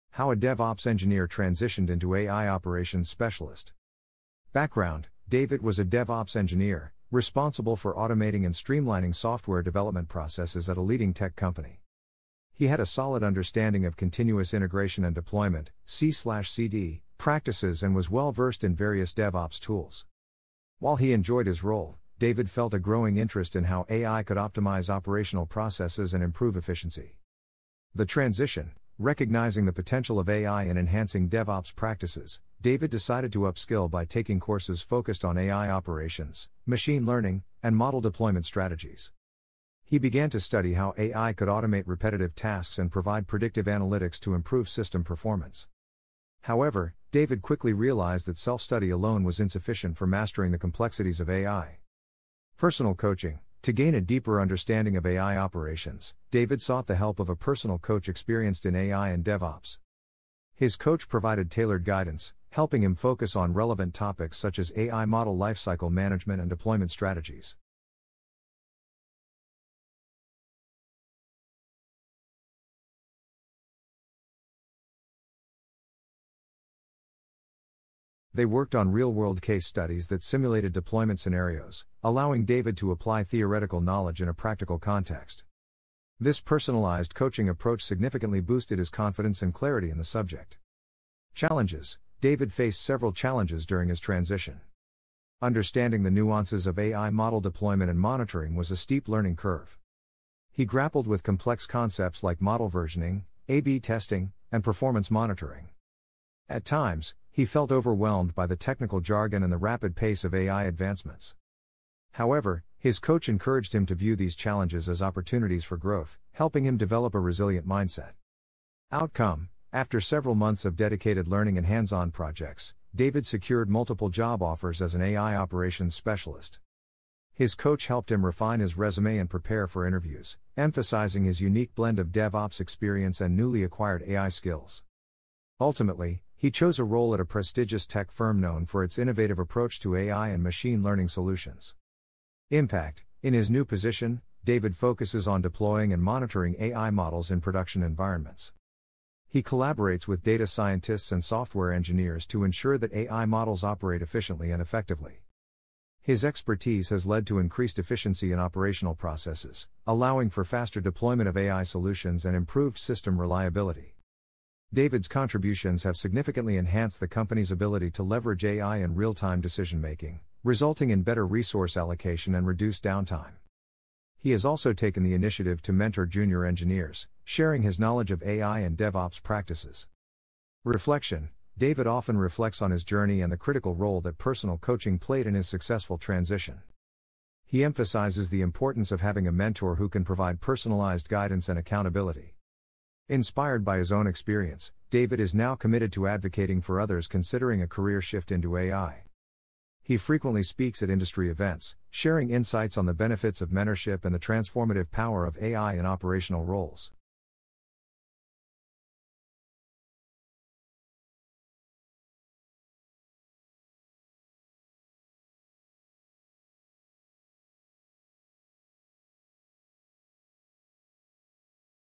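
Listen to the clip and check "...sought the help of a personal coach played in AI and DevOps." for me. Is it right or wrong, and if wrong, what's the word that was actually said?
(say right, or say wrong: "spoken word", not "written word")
wrong: "experienced", not "played".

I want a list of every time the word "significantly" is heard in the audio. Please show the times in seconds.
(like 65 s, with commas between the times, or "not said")
87 s, 165 s.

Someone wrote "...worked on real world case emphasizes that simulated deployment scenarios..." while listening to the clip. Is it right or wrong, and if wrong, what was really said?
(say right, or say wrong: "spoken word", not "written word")
wrong: "studies", not "emphasizes".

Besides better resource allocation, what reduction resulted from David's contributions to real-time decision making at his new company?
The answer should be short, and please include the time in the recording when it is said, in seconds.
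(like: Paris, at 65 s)
Reduced downtime, at 172 s.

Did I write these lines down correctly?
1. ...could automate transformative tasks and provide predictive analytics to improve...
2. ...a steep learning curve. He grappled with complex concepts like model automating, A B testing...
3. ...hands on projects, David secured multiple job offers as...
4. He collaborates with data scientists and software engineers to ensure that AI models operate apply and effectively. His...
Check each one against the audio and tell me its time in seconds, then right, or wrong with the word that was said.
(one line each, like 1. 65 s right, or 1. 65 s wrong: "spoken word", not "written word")
1. 41 s wrong: "repetitive", not "transformative"
2. 98 s wrong: "versioning", not "automating"
3. 121 s right
4. 149 s wrong: "efficiently", not "apply".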